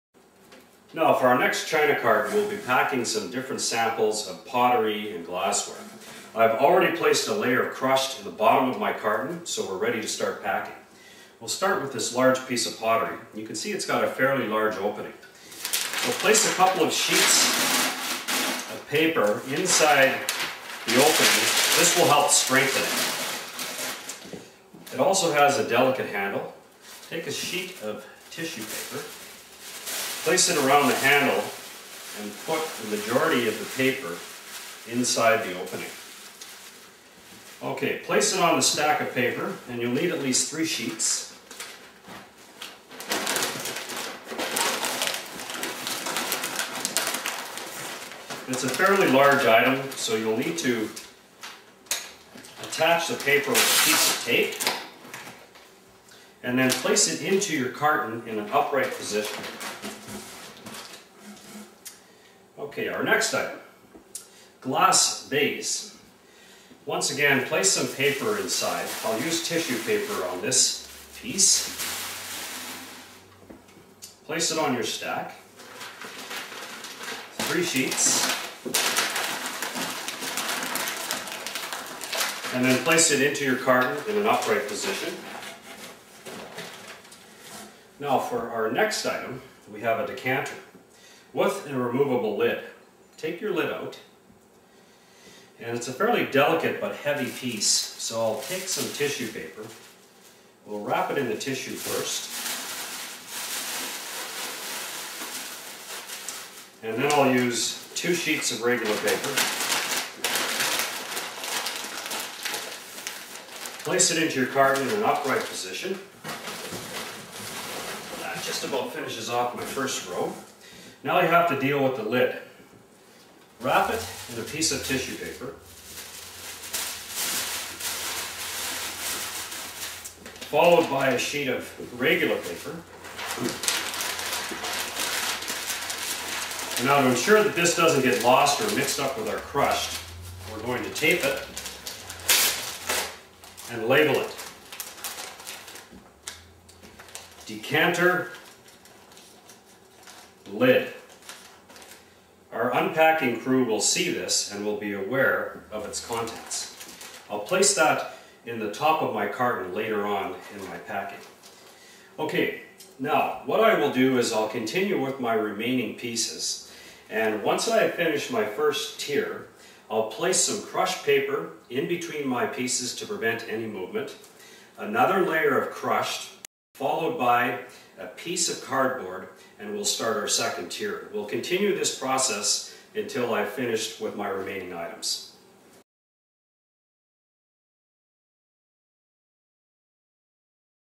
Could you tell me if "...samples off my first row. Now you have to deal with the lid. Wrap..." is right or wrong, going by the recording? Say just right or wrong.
wrong.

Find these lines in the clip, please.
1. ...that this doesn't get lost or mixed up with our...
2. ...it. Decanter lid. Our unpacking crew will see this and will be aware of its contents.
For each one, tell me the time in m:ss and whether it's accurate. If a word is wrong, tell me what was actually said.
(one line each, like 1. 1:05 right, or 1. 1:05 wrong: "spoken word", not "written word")
1. 2:17 right
2. 2:24 right.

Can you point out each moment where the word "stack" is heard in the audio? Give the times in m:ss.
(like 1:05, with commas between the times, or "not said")
0:38, 1:14.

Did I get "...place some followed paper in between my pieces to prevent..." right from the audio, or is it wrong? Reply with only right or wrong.
wrong.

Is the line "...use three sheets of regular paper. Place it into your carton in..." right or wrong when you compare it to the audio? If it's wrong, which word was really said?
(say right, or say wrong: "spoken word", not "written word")
wrong: "two", not "three".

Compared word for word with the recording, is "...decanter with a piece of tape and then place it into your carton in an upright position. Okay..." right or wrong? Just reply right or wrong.
wrong.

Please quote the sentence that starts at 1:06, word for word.
Once again, place some paper inside.